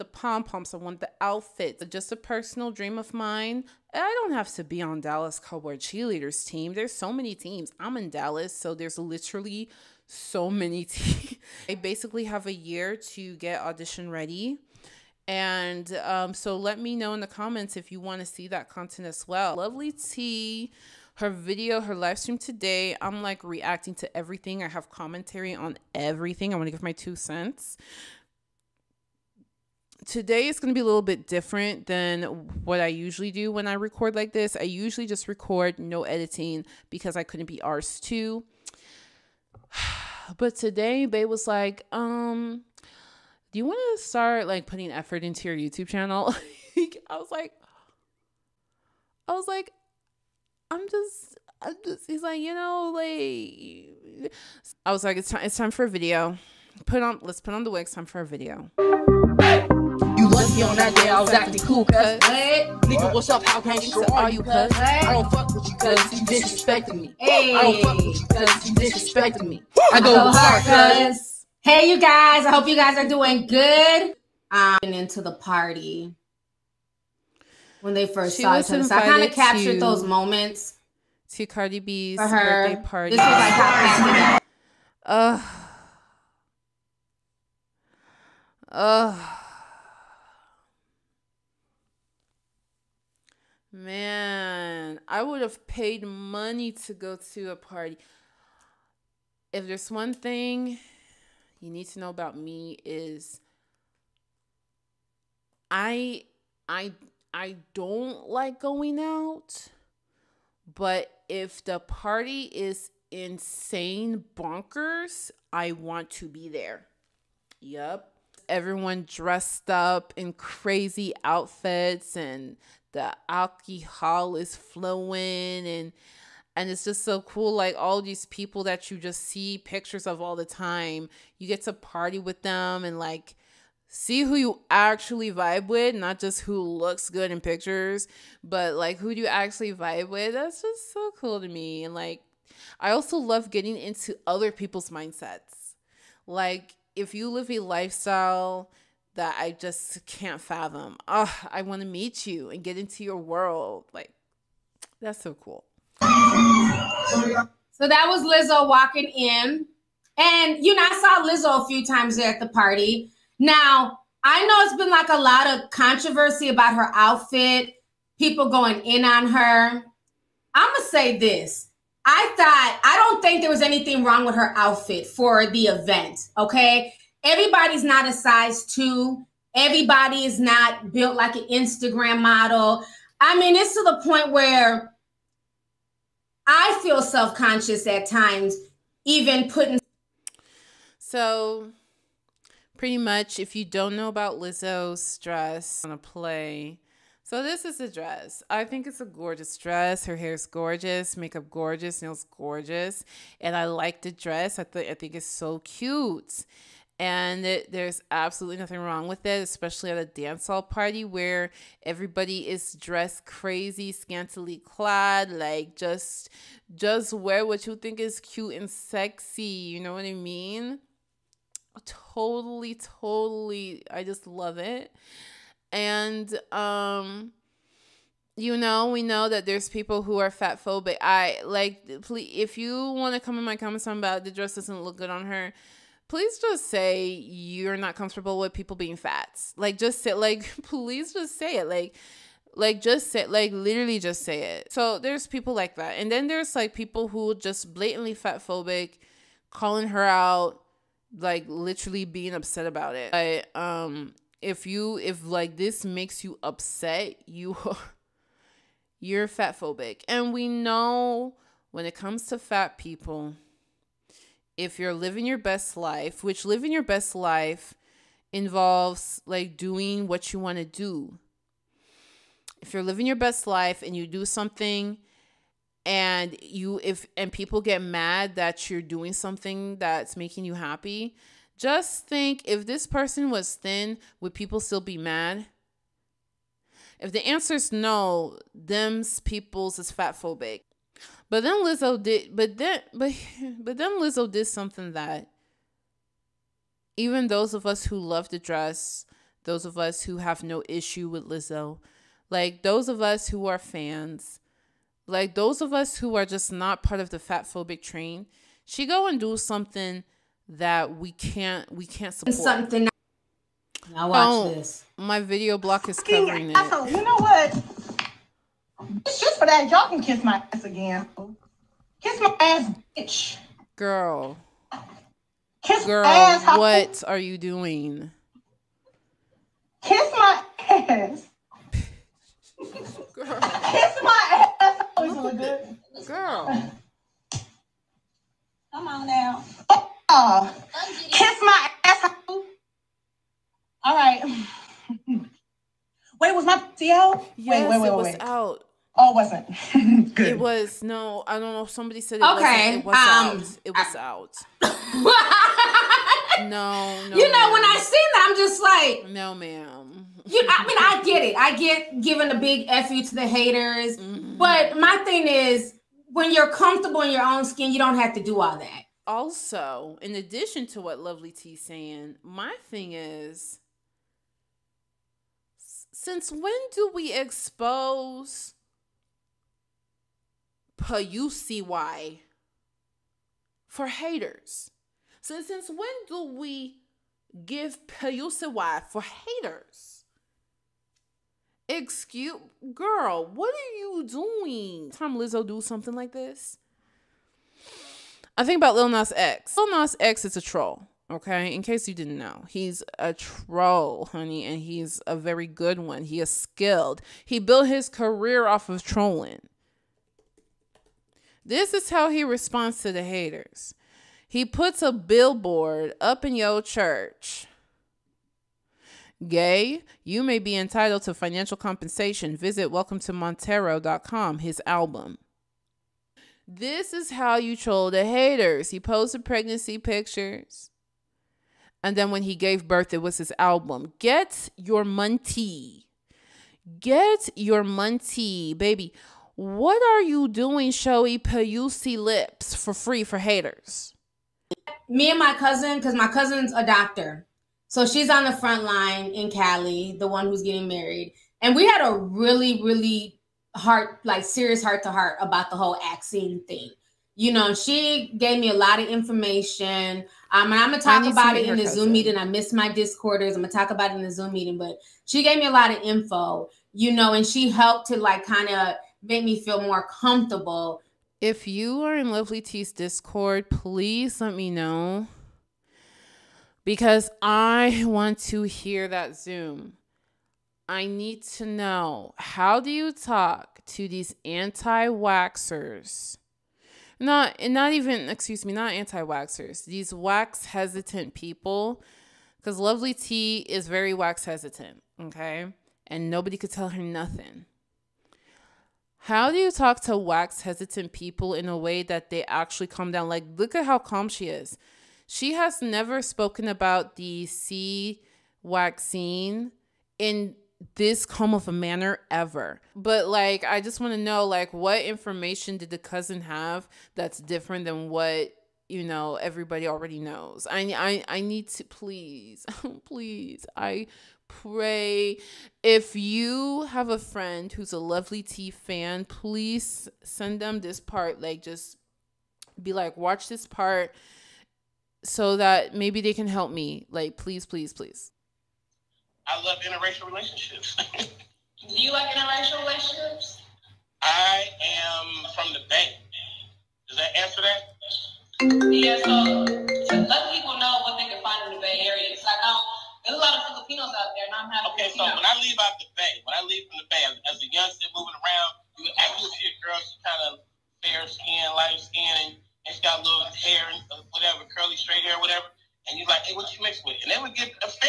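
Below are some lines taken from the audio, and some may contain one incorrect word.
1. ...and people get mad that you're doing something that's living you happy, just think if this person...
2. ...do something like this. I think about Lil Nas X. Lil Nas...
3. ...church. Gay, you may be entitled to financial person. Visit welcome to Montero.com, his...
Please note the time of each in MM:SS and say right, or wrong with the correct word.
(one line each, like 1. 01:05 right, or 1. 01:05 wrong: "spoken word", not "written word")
1. 04:37 wrong: "making", not "living"
2. 06:35 right
3. 06:56 wrong: "compensation", not "person".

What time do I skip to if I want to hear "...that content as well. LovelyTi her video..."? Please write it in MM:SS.
00:18.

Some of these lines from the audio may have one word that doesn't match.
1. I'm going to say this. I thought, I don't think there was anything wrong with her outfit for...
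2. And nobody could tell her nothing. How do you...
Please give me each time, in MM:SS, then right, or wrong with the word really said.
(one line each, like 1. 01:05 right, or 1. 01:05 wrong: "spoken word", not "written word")
1. 02:50 right
2. 08:15 right.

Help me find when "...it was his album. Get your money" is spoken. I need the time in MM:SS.
07:12.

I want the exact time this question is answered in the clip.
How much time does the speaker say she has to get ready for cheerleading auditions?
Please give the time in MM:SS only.
00:12.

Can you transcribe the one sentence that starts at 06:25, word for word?
So since when do we give PUCY for haters?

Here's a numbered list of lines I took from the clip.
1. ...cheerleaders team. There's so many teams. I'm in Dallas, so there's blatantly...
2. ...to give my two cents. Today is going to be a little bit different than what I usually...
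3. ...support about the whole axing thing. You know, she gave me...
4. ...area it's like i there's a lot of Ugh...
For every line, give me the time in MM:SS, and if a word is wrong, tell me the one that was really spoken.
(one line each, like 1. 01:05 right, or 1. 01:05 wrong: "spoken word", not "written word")
1. 00:05 wrong: "literally", not "blatantly"
2. 00:26 right
3. 07:34 wrong: "heart", not "support"
4. 09:11 wrong: "Filipinos", not "Ugh".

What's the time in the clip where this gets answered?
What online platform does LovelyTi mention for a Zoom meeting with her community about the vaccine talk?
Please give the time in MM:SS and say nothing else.
07:52.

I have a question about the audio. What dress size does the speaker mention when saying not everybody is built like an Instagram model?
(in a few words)
size 2.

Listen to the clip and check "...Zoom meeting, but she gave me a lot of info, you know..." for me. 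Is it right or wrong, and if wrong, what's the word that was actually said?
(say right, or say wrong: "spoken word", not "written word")
right.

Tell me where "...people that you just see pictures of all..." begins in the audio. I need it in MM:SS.
02:08.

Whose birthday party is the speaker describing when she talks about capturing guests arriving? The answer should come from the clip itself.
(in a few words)
Cardi B.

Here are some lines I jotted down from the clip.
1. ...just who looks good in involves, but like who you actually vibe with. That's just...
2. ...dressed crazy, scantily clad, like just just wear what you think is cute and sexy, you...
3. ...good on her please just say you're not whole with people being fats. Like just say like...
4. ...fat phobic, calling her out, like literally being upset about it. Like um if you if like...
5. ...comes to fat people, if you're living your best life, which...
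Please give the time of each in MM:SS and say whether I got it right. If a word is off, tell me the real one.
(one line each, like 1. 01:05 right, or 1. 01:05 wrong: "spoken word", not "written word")
1. 02:16 wrong: "pictures", not "involves"
2. 03:32 right
3. 03:54 wrong: "comfortable", not "whole"
4. 04:08 right
5. 04:21 right.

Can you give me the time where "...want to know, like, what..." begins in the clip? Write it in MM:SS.
08:33.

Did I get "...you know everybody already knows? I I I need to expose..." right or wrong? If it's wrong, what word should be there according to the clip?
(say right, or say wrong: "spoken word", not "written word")
wrong: "please", not "expose".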